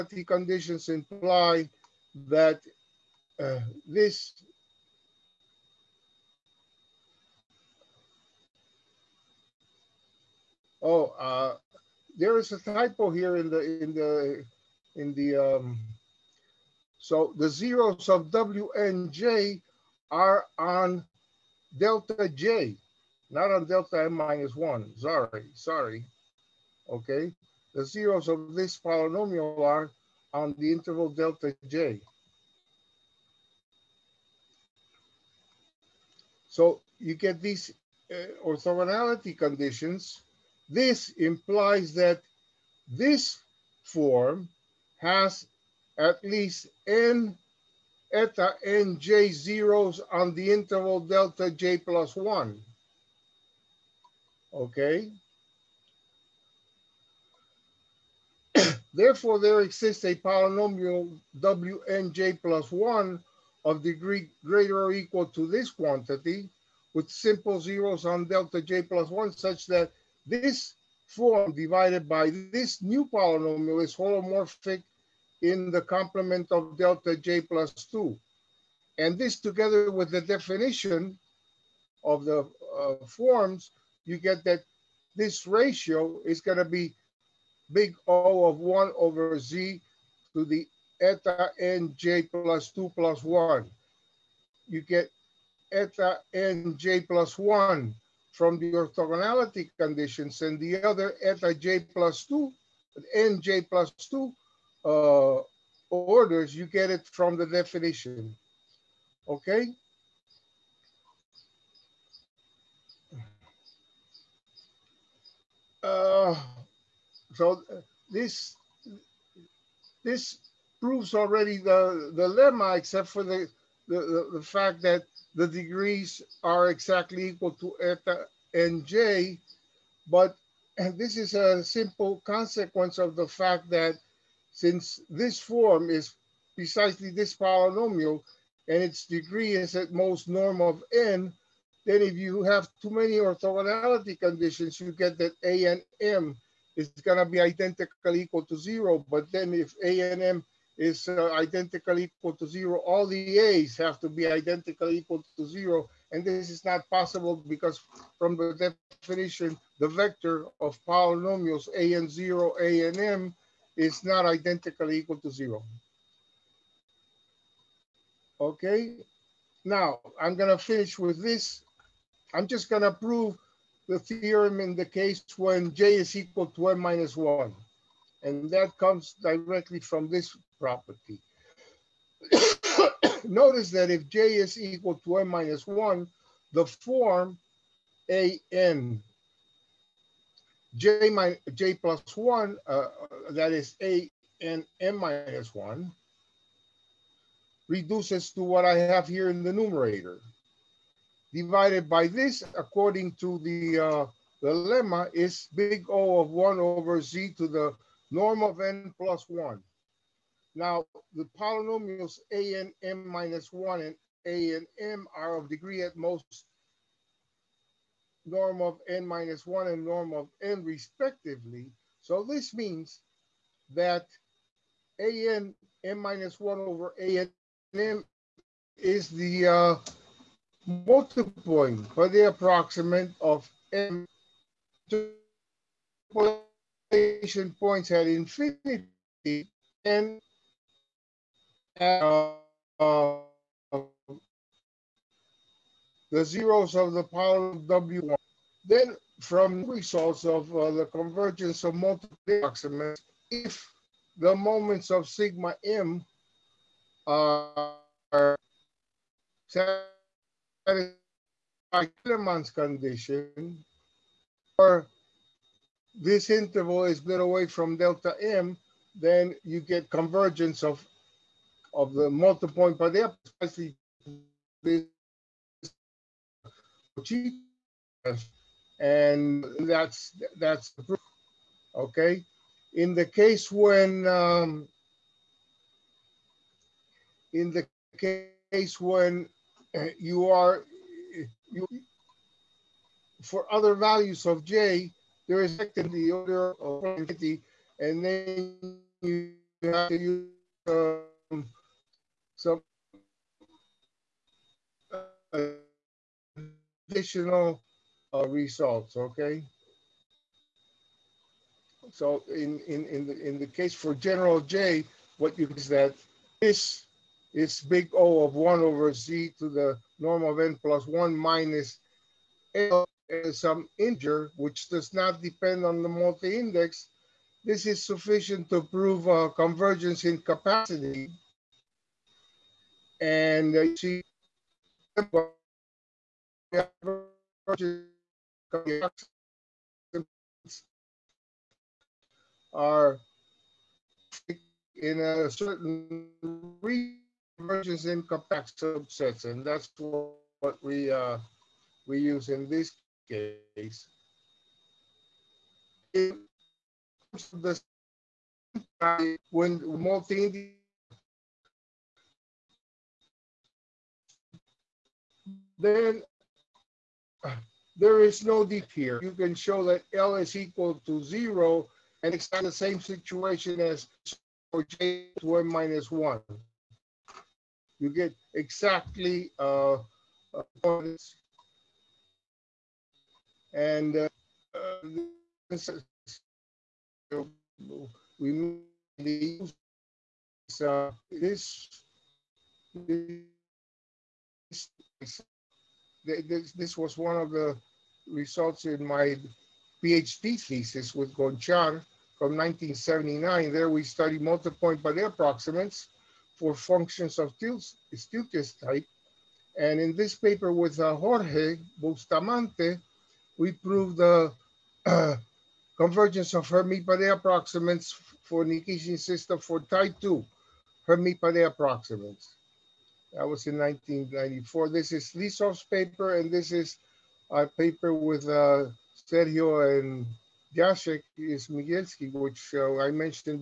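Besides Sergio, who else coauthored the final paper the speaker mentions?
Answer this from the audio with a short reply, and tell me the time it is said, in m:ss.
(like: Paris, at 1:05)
Jacek Smigielski, at 7:10.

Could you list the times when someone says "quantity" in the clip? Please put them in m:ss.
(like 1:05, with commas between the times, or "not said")
1:05.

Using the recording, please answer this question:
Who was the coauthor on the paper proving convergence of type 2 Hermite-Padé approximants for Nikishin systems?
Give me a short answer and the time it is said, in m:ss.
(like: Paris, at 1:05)
Jorge Bustamante, at 6:50.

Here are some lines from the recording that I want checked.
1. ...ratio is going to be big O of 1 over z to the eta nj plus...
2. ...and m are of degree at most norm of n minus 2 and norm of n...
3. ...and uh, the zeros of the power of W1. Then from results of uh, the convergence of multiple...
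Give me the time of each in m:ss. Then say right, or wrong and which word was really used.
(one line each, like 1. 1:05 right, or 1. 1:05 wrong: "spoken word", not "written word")
1. 1:25 right
2. 3:34 wrong: "1", not "2"
3. 3:59 right.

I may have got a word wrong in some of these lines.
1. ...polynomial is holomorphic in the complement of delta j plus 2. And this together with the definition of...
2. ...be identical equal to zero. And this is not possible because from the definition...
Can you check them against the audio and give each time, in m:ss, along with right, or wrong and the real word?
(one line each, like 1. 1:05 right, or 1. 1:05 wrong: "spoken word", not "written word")
1. 1:13 right
2. 2:34 right.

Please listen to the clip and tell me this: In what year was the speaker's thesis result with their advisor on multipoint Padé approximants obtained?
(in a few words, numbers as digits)
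1979.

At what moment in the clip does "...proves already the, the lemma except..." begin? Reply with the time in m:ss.
2:00.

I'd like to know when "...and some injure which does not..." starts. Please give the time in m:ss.
5:23.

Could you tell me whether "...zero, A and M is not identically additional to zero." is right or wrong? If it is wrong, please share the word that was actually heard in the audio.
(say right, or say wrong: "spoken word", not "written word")
wrong: "equal", not "additional".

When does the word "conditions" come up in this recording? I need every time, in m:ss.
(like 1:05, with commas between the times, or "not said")
0:00, 0:39, 1:39, 2:24, 4:22.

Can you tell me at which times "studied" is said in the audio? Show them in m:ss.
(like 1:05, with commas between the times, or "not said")
6:43.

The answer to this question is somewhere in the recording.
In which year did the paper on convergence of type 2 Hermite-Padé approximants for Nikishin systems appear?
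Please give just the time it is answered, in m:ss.
7:03.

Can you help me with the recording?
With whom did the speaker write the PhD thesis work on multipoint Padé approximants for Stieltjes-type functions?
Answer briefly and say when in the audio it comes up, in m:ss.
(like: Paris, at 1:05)
Gonchar, at 6:41.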